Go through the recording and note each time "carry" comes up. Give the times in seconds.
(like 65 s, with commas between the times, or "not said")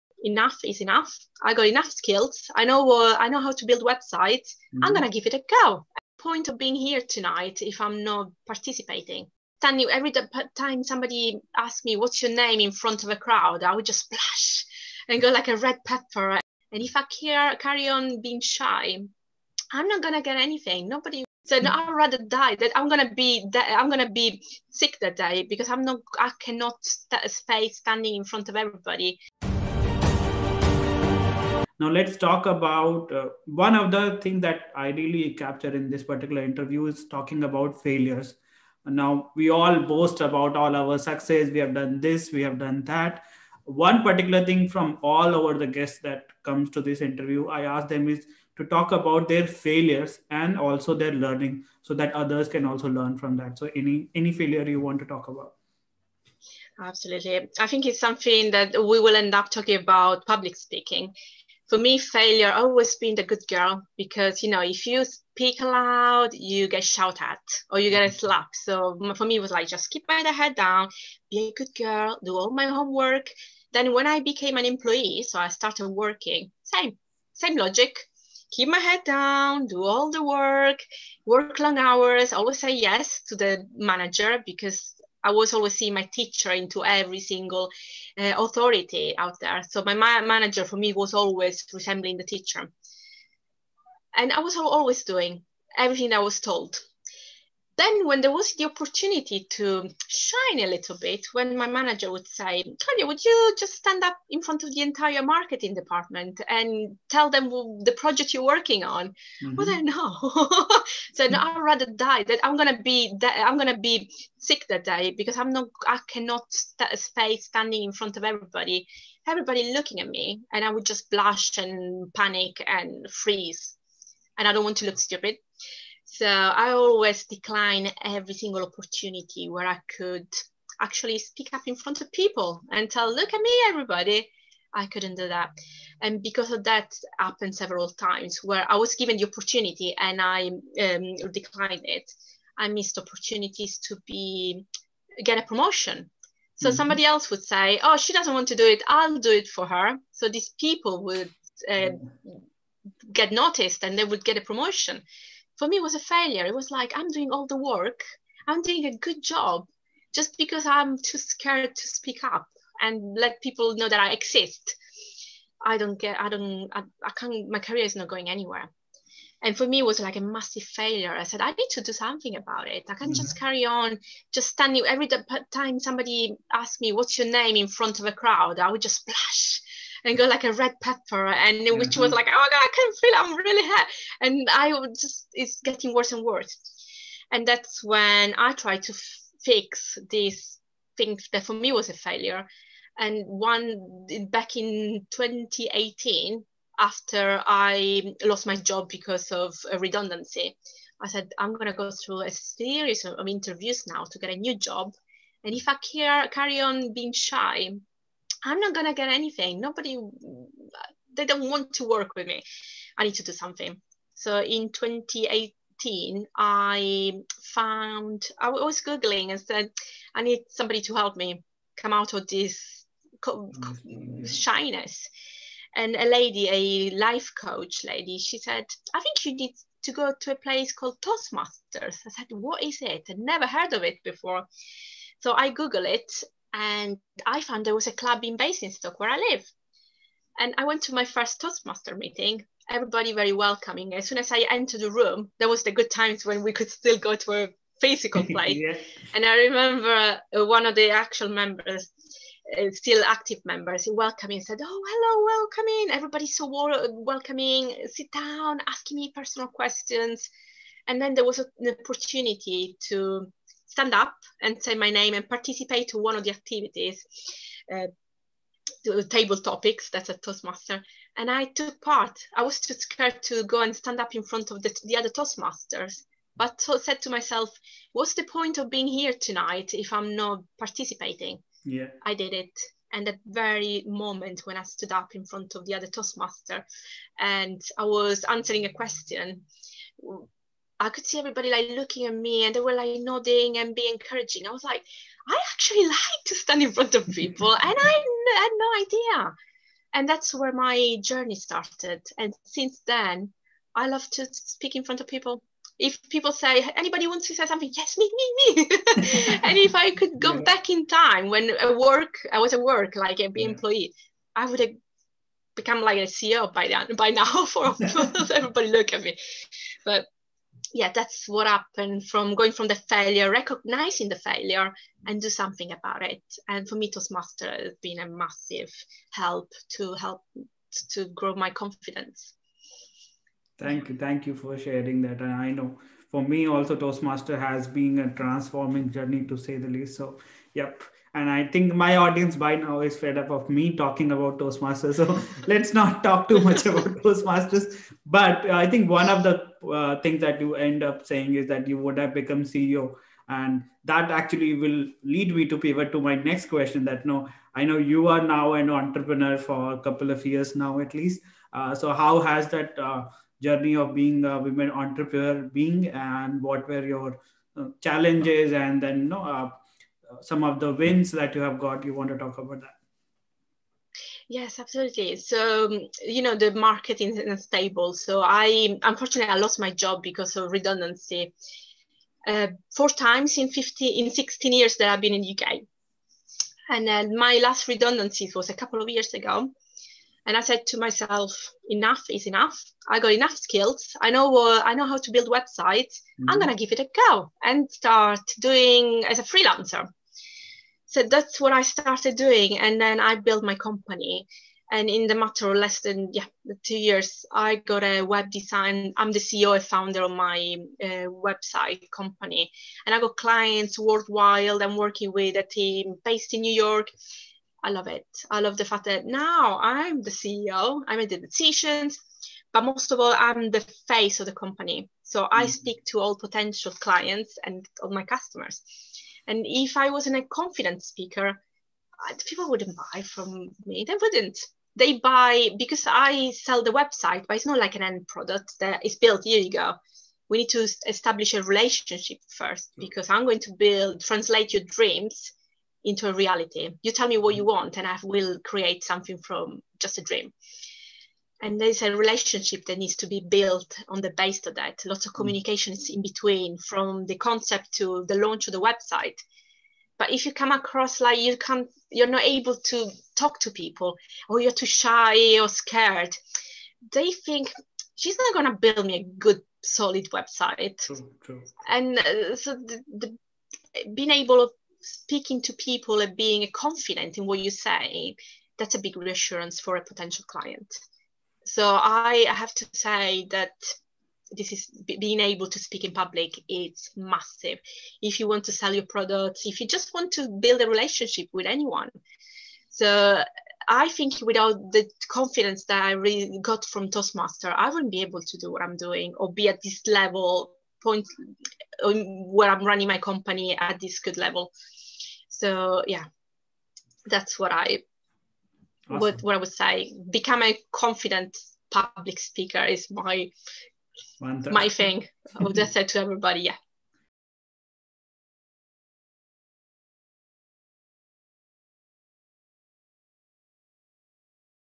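17 s, 173 s, 206 s.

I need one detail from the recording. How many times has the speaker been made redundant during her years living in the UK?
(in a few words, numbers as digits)
4.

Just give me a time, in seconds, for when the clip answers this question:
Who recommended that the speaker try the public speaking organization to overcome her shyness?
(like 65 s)
226 s.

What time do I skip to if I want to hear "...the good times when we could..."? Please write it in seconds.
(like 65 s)
245 s.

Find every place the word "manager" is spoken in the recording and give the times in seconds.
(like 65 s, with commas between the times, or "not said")
83 s, 90 s, 101 s.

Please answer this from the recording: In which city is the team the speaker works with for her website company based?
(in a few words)
New York.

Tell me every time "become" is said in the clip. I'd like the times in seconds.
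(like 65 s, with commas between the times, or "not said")
315 s, 352 s, 510 s.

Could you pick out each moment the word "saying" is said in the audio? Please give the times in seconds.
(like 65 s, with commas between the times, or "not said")
351 s, 509 s.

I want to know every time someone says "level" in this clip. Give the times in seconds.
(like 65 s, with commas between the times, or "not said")
499 s, 504 s.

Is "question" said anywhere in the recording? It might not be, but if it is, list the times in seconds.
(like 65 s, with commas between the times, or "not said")
259 s, 288 s, 356 s.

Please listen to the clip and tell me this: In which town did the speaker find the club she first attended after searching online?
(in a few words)
Basingstoke.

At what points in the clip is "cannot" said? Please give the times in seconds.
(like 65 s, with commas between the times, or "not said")
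26 s, 116 s.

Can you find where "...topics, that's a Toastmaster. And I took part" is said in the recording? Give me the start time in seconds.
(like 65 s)
269 s.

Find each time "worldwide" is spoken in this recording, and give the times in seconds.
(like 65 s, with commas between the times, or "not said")
413 s.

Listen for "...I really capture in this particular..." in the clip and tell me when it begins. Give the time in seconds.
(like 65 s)
34 s.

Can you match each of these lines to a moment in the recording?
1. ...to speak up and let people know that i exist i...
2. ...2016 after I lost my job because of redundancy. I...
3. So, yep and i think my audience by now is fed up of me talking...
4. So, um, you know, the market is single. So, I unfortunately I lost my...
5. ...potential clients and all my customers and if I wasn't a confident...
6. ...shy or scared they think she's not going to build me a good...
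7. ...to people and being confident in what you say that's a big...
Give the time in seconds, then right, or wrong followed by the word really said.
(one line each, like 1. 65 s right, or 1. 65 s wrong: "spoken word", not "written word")
1. 161 s right
2. 195 s wrong: "2018", not "2016"
3. 339 s right
4. 375 s wrong: "unstable", not "single"
5. 426 s right
6. 464 s right
7. 475 s right.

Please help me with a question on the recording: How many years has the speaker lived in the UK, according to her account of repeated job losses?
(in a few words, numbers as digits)
16.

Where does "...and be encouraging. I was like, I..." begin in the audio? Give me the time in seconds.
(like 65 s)
293 s.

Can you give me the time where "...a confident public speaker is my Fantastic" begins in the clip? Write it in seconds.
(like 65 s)
510 s.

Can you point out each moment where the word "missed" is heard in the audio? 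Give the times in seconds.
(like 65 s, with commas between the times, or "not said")
142 s.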